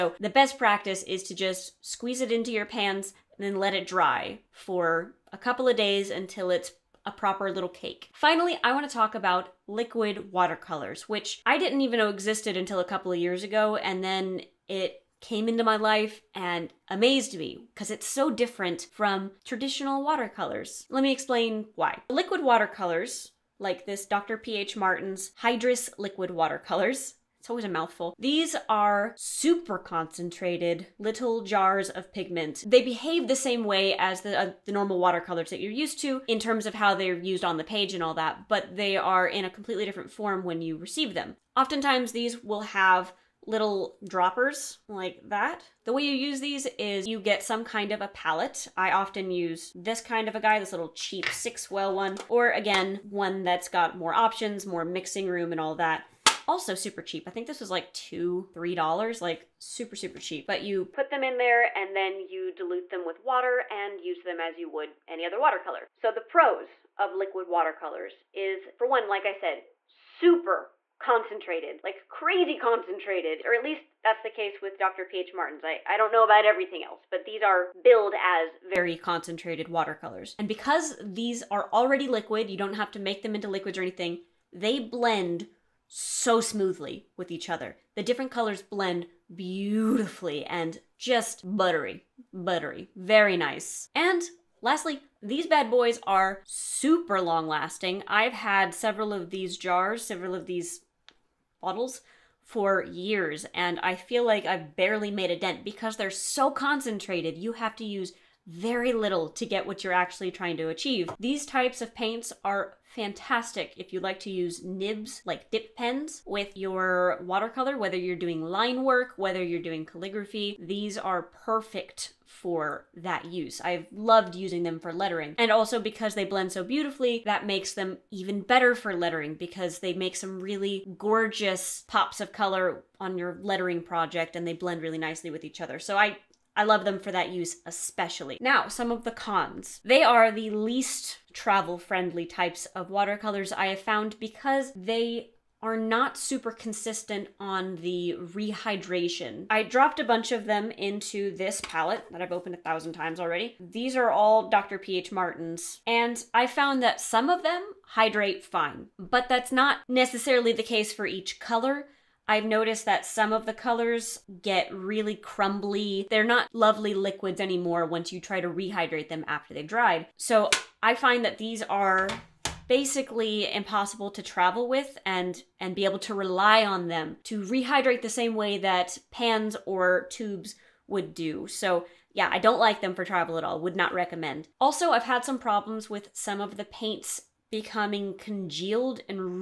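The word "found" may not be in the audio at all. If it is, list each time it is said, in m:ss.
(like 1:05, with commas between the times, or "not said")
2:23, 2:36.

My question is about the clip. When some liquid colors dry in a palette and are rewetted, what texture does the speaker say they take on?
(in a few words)
Crumbly.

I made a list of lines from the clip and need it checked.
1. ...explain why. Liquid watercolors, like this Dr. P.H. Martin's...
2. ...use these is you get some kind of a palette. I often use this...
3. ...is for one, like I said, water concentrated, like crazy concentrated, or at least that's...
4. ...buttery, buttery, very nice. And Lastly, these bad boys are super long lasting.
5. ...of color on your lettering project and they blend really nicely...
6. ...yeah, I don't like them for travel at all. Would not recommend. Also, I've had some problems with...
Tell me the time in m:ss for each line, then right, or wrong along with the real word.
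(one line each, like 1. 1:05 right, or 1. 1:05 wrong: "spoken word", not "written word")
1. 0:21 right
2. 0:46 right
3. 1:08 wrong: "super", not "water"
4. 1:31 right
5. 2:12 right
6. 3:02 right.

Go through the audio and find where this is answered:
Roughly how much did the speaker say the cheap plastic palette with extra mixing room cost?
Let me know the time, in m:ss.
0:57.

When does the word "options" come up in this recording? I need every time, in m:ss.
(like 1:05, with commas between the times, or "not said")
0:54.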